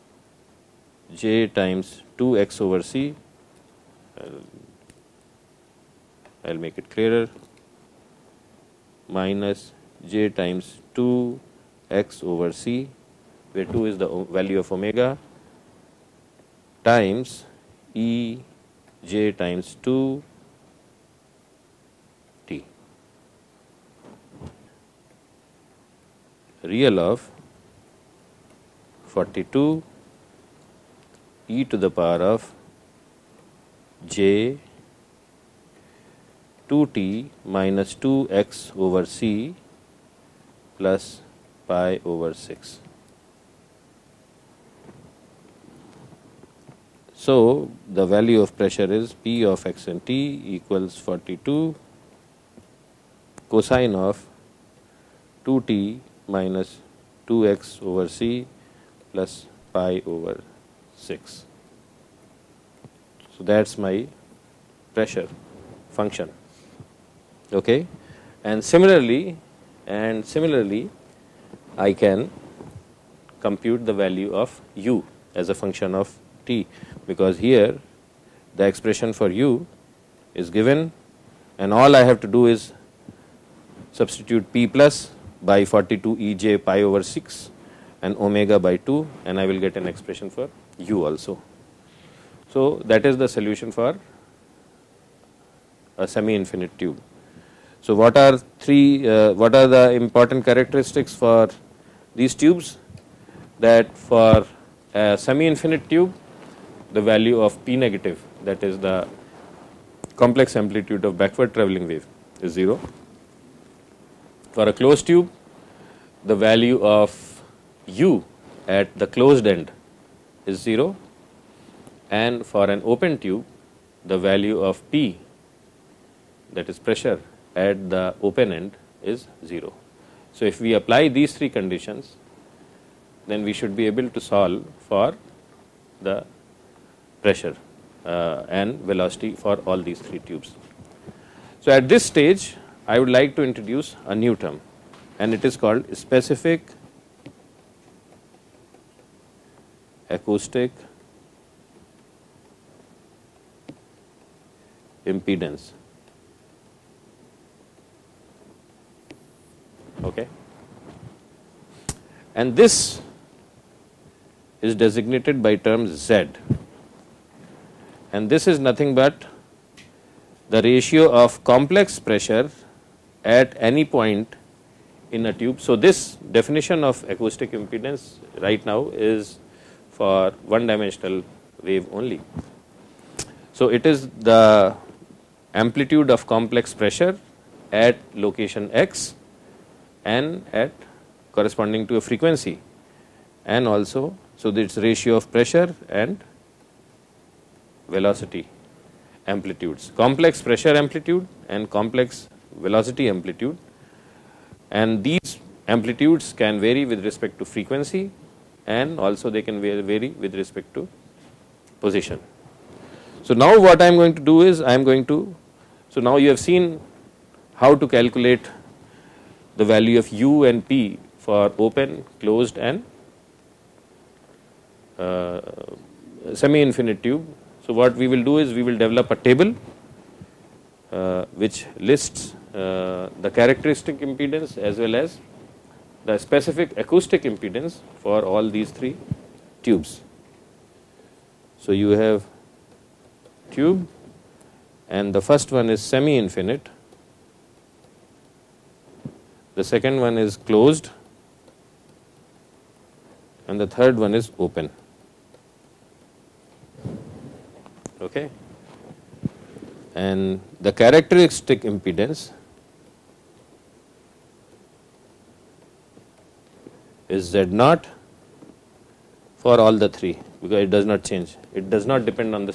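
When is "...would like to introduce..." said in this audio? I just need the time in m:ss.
2:22.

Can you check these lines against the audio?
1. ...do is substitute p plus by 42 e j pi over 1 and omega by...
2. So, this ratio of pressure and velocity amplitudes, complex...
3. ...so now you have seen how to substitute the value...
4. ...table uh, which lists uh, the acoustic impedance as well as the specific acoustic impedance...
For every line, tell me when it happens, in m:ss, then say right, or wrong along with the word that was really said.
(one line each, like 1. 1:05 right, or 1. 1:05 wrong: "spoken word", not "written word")
1. 1:22 wrong: "6", not "1"
2. 3:14 right
3. 3:35 wrong: "calculate", not "substitute"
4. 3:49 wrong: "characteristic", not "acoustic".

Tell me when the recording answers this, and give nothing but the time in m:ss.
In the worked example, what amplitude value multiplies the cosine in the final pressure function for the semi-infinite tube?
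0:50.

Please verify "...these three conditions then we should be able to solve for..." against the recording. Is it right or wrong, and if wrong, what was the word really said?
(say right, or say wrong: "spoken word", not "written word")
right.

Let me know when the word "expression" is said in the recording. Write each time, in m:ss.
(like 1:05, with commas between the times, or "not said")
1:18, 1:29.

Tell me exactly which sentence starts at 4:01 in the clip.
So, you have tube and the first one is semi infinite, the second one is closed and the third one is open.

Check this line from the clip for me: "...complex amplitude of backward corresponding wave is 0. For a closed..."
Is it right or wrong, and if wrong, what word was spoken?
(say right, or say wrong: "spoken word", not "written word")
wrong: "travelling", not "corresponding".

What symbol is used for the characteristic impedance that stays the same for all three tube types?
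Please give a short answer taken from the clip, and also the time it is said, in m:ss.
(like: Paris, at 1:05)
Z naught, at 4:27.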